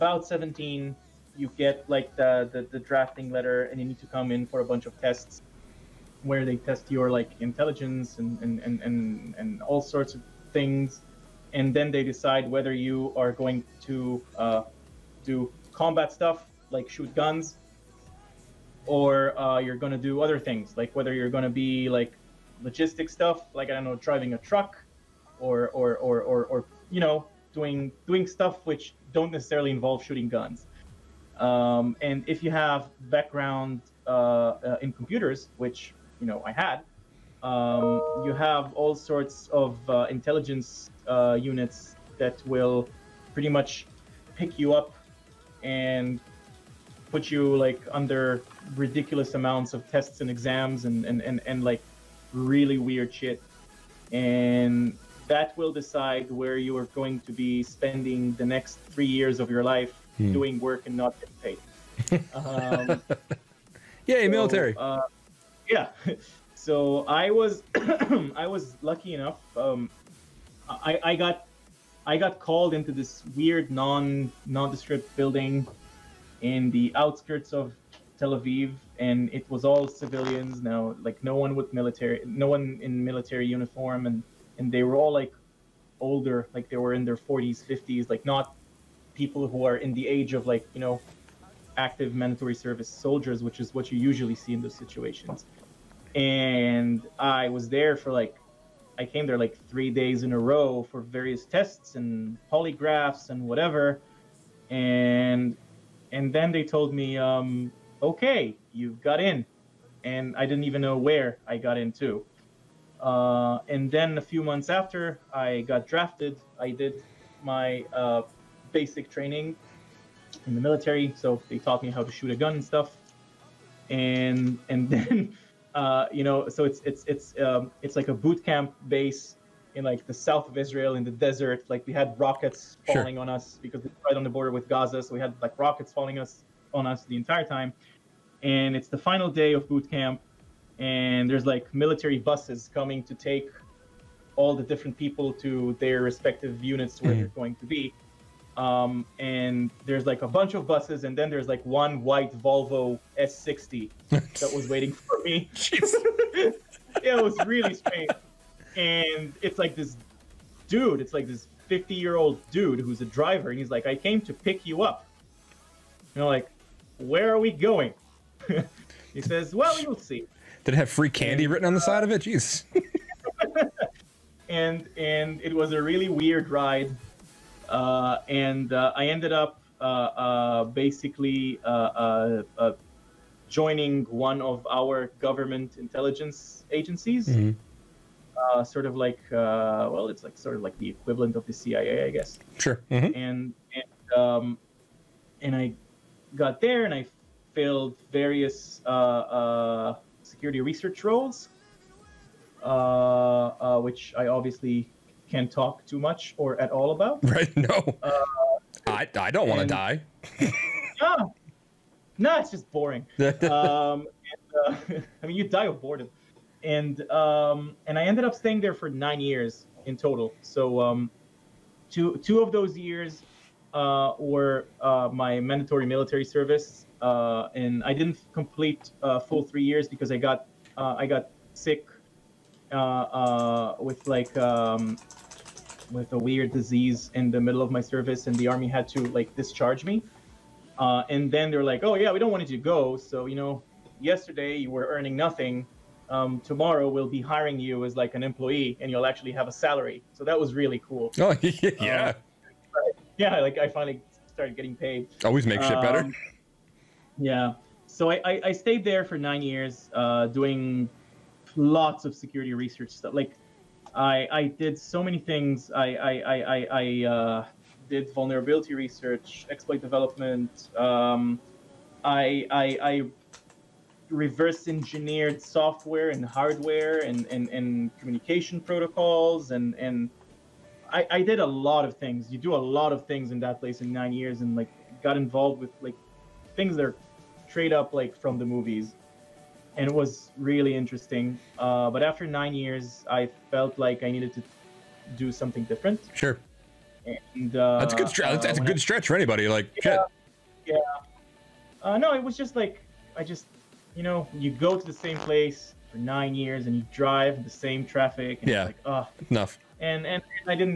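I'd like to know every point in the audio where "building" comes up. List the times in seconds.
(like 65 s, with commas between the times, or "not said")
75 s.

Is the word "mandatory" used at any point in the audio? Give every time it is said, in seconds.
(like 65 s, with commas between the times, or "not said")
92 s, 225 s.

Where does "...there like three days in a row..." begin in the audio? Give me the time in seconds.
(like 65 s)
99 s.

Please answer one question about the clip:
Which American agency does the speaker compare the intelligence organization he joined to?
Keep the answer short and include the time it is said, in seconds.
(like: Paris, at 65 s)
CIA, at 191 s.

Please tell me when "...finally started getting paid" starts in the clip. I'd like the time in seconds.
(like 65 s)
253 s.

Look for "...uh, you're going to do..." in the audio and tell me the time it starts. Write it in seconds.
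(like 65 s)
19 s.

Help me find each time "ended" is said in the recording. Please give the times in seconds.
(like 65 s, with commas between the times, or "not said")
179 s, 218 s.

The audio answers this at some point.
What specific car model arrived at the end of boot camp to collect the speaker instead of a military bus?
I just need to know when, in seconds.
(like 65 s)
152 s.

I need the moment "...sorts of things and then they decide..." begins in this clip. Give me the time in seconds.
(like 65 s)
9 s.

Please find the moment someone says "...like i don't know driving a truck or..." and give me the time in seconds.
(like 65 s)
23 s.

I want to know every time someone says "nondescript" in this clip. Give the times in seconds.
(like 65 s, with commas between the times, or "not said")
74 s.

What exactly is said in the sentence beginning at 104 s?
And and then they told me, um, okay, you got in, and I didn't even know where I got into.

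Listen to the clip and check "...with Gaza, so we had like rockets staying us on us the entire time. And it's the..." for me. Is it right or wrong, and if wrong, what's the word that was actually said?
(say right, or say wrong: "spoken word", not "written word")
wrong: "falling", not "staying".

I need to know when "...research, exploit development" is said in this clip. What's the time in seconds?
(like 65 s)
268 s.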